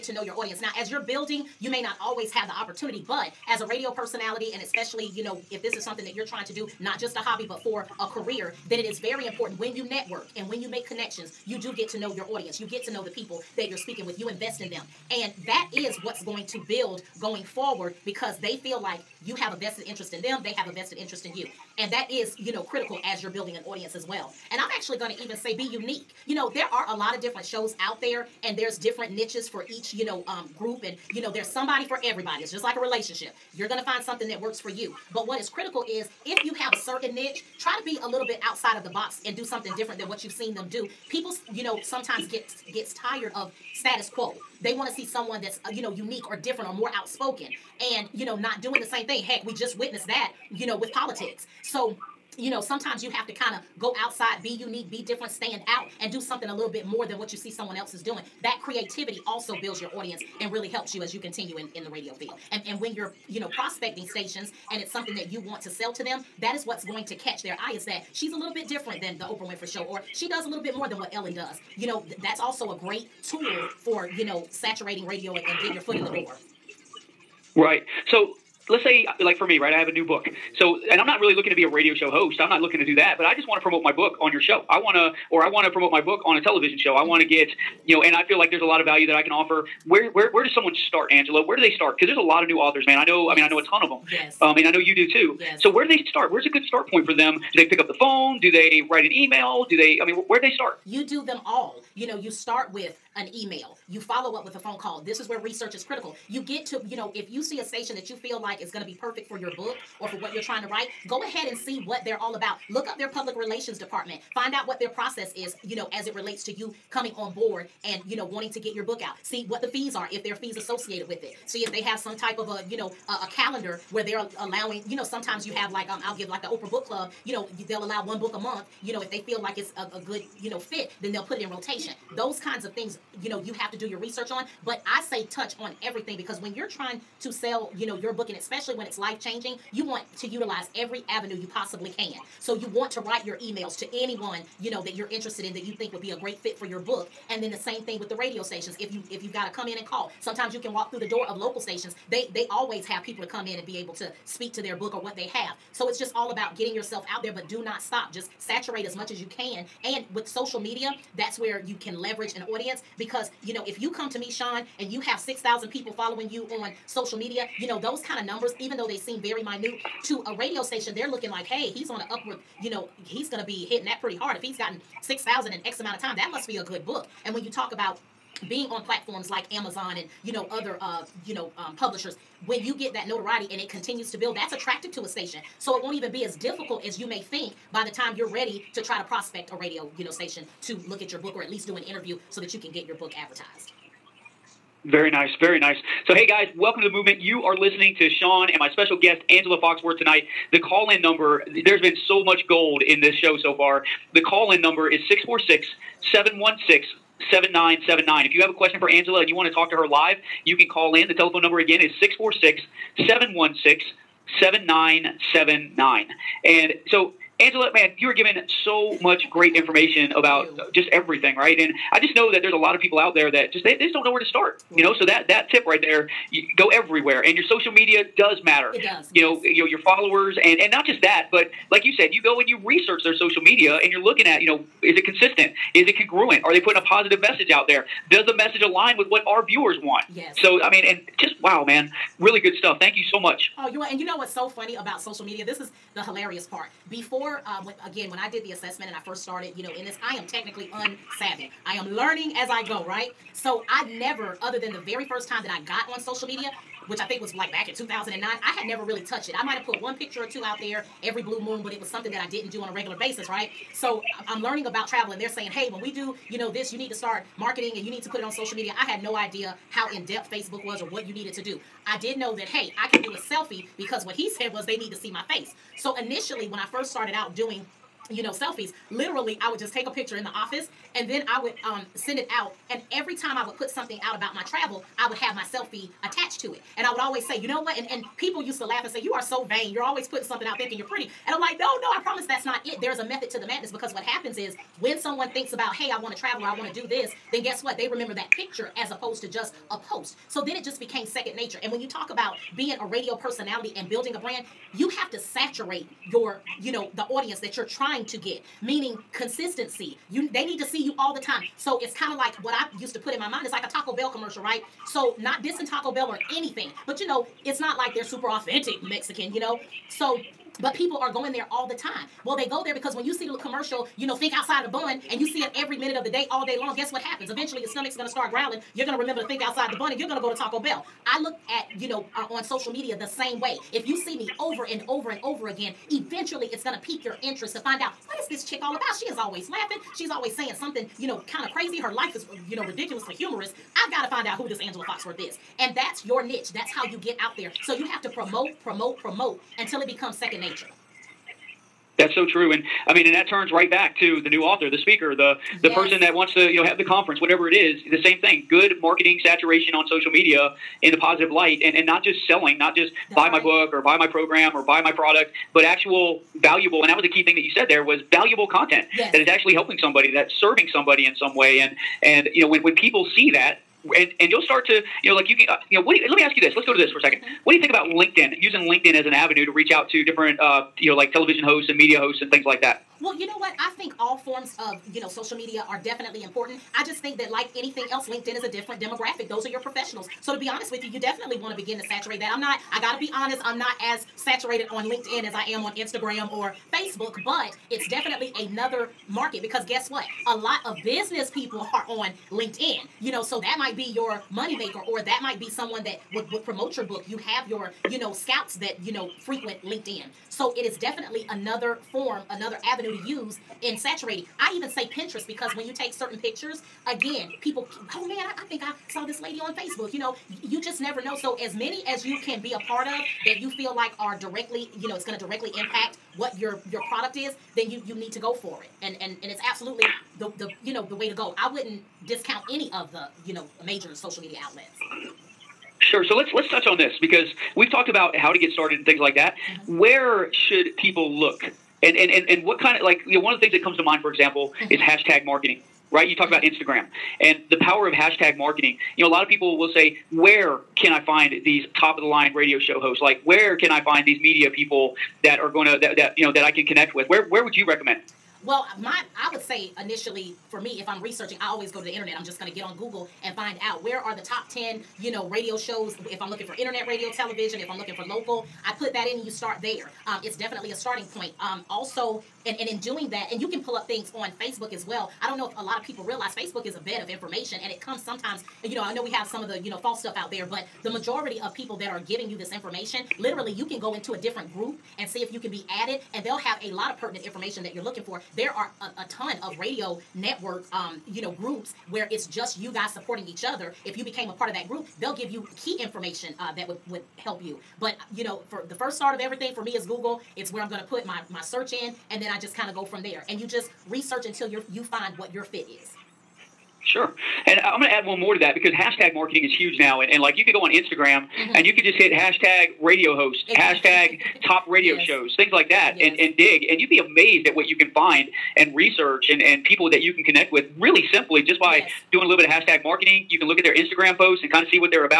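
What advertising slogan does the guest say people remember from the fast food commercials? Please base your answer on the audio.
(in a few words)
Think outside the bun.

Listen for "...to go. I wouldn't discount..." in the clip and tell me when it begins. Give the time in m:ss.
7:11.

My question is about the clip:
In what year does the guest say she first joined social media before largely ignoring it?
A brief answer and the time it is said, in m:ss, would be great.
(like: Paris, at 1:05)
2009, at 4:17.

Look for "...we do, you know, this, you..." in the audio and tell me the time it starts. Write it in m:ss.
4:25.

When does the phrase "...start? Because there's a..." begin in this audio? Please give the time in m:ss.
1:31.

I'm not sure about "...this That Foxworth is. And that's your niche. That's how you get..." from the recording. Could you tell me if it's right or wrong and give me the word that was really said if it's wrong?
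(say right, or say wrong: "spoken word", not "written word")
wrong: "Angela", not "That".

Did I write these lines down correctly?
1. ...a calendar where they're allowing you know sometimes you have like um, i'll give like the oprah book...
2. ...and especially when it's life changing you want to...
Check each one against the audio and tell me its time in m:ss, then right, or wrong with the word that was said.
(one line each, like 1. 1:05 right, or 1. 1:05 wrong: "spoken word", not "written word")
1. 2:03 right
2. 2:18 right.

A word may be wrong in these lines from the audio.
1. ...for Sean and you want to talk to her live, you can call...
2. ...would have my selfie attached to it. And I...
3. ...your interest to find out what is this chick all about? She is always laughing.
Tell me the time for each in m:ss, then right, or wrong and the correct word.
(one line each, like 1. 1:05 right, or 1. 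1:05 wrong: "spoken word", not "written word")
1. 3:28 wrong: "Angela", not "Sean"
2. 4:45 right
3. 5:37 right.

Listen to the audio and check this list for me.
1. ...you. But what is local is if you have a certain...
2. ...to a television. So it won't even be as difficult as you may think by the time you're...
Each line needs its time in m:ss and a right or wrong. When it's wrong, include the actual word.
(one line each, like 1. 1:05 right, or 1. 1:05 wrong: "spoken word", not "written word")
1. 0:34 wrong: "critical", not "local"
2. 3:04 wrong: "station", not "television".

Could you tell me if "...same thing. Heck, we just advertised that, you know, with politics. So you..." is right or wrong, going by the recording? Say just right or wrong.
wrong.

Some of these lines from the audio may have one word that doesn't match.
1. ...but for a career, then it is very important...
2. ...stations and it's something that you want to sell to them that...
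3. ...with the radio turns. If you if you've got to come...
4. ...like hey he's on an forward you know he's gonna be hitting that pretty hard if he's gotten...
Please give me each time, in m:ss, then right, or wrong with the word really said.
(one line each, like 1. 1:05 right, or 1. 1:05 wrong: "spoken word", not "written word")
1. 0:07 right
2. 1:04 right
3. 2:27 wrong: "stations", not "turns"
4. 2:51 wrong: "upward", not "forward".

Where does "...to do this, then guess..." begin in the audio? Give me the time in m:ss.
4:56.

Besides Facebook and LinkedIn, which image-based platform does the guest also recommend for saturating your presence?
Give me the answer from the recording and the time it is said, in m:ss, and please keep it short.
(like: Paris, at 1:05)
Pinterest, at 6:54.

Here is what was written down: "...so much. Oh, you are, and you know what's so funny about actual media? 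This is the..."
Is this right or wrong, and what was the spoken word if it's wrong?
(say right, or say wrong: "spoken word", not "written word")
wrong: "social", not "actual".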